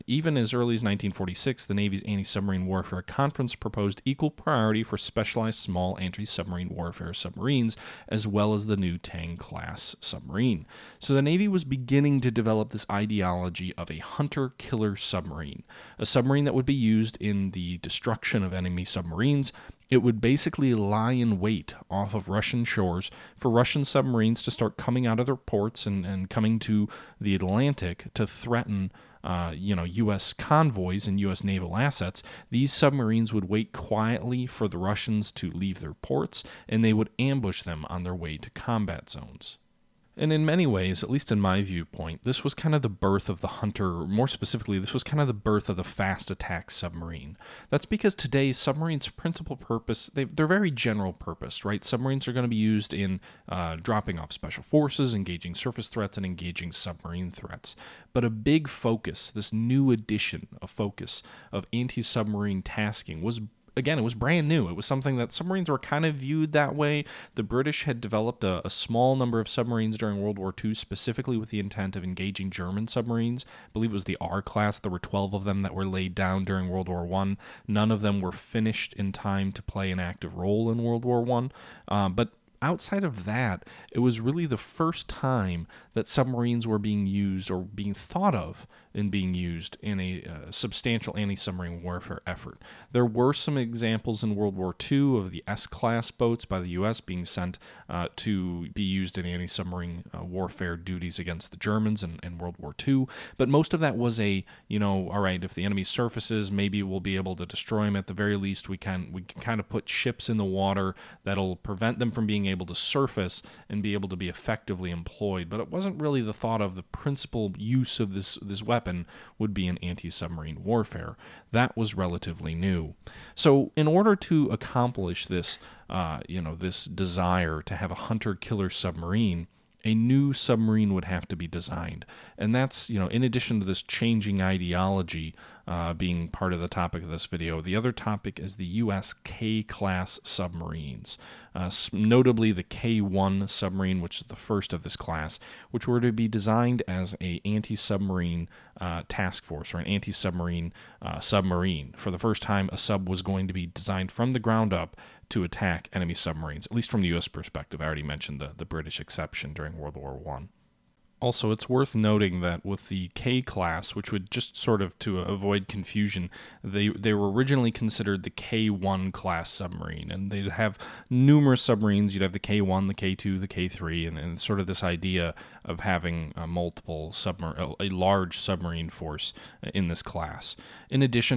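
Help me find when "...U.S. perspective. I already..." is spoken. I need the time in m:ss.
2:37.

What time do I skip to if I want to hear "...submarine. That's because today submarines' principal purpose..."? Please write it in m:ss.
0:46.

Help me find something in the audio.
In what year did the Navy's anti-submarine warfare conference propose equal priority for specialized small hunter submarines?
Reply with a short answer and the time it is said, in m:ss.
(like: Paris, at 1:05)
1946, at 0:00.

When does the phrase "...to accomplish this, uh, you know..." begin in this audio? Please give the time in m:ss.
2:04.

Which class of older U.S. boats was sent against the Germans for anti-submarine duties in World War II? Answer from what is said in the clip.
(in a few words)
S class.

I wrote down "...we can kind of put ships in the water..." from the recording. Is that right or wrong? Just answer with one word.
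right.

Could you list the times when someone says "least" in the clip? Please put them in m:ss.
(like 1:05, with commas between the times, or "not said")
0:41, 1:48, 2:36.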